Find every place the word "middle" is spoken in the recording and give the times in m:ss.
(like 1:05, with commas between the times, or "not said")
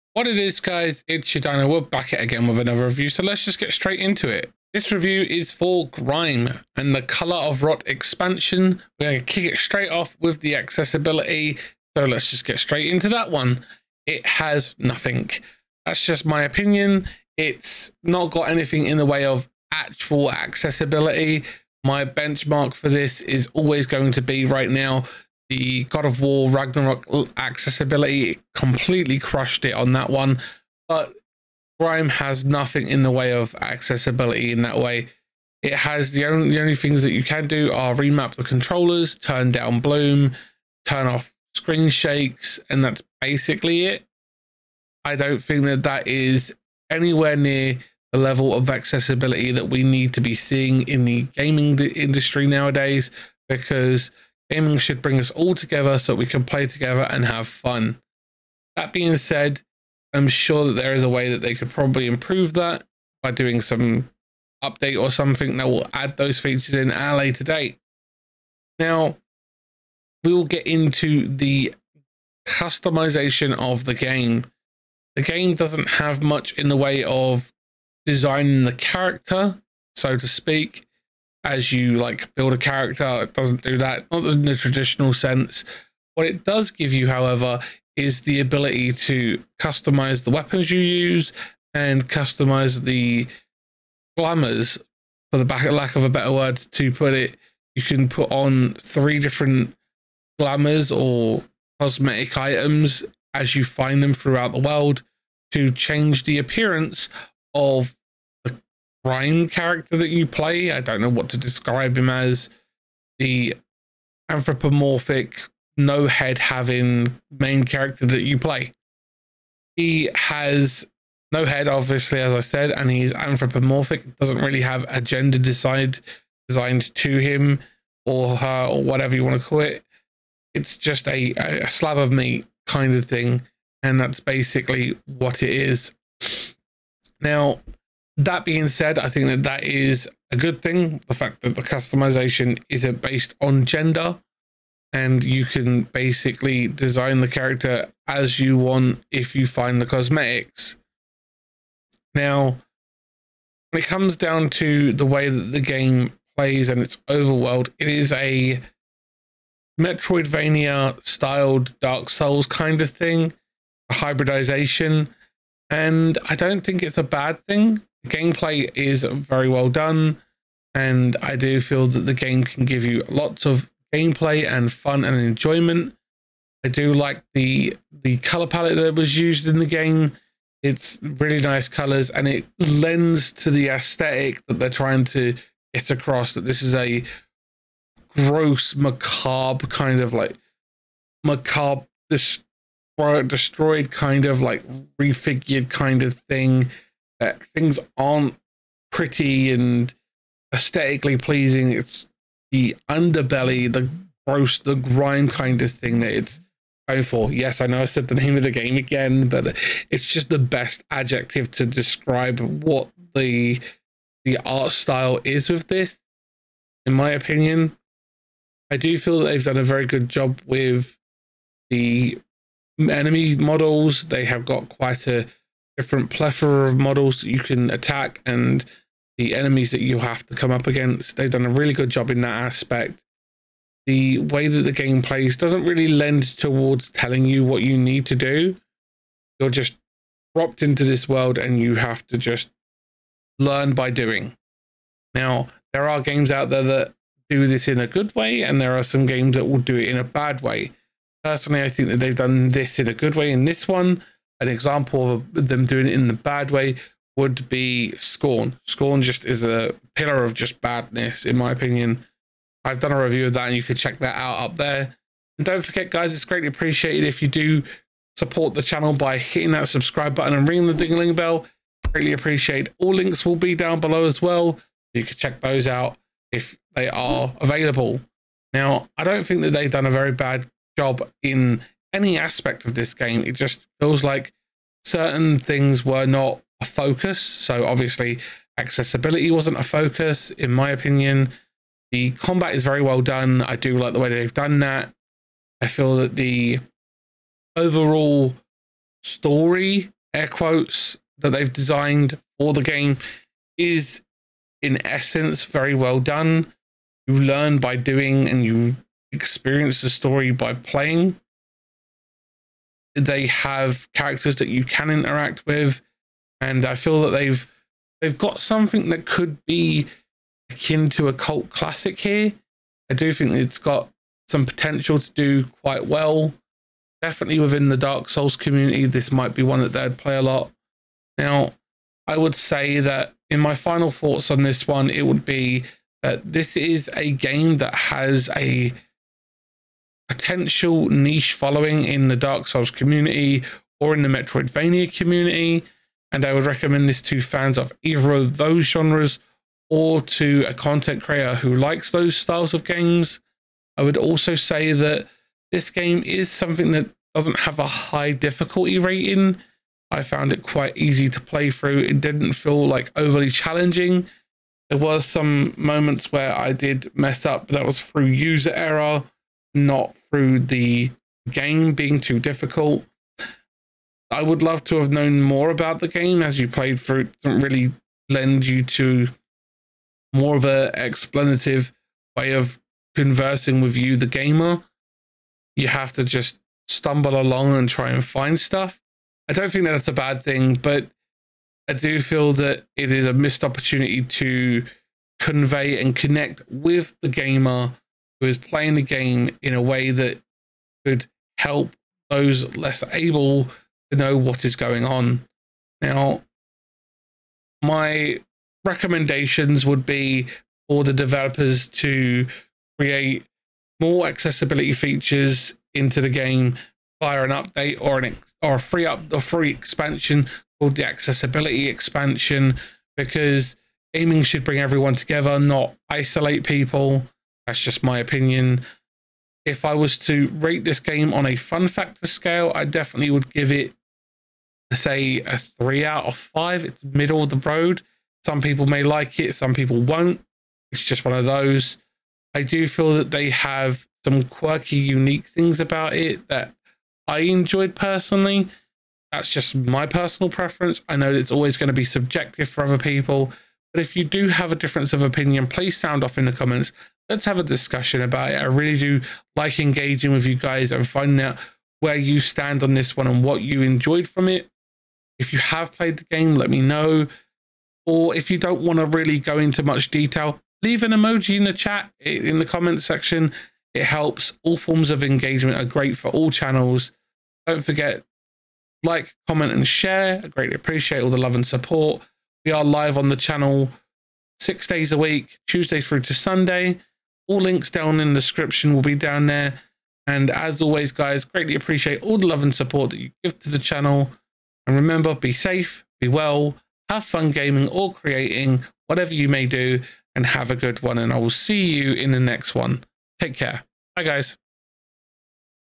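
7:16.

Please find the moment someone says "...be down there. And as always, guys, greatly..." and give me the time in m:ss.
8:08.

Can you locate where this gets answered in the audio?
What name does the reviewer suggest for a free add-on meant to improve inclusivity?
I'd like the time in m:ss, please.
7:00.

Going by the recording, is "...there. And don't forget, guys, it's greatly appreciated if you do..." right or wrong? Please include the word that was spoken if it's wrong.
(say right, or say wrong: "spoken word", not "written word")
right.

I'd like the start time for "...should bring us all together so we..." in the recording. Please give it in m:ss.
0:54.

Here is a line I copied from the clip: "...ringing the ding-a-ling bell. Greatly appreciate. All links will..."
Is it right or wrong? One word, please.
right.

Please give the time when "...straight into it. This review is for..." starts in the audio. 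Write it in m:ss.
0:03.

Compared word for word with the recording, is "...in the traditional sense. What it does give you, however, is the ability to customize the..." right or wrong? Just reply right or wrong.
right.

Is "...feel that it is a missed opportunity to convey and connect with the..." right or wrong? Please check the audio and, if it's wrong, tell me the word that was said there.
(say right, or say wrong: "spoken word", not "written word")
right.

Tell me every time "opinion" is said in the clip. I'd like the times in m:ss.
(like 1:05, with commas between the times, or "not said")
0:16, 3:37, 4:21, 4:50, 7:07, 7:35.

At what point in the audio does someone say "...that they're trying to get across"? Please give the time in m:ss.
3:04.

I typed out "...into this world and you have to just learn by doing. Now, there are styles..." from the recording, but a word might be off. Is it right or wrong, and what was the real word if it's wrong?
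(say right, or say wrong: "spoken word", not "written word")
wrong: "games", not "styles".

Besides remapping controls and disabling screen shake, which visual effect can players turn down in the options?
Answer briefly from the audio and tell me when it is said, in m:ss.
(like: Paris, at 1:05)
Bloom, at 0:39.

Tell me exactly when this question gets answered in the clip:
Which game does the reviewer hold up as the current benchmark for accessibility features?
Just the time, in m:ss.
0:25.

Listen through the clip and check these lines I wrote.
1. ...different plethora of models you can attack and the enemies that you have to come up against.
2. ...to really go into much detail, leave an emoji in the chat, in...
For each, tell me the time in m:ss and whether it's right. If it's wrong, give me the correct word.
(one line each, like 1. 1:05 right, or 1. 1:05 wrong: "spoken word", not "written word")
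1. 3:45 right
2. 7:48 right.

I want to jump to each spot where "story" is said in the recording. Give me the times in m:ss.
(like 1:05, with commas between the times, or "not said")
4:59, 5:09.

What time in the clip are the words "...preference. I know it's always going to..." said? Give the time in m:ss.
7:30.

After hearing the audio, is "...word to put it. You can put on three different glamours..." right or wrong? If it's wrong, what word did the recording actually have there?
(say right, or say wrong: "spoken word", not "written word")
right.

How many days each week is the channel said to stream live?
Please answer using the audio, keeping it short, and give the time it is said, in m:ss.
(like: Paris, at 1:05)
6, at 8:04.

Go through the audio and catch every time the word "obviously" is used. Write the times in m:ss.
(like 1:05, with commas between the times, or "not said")
2:01, 4:47.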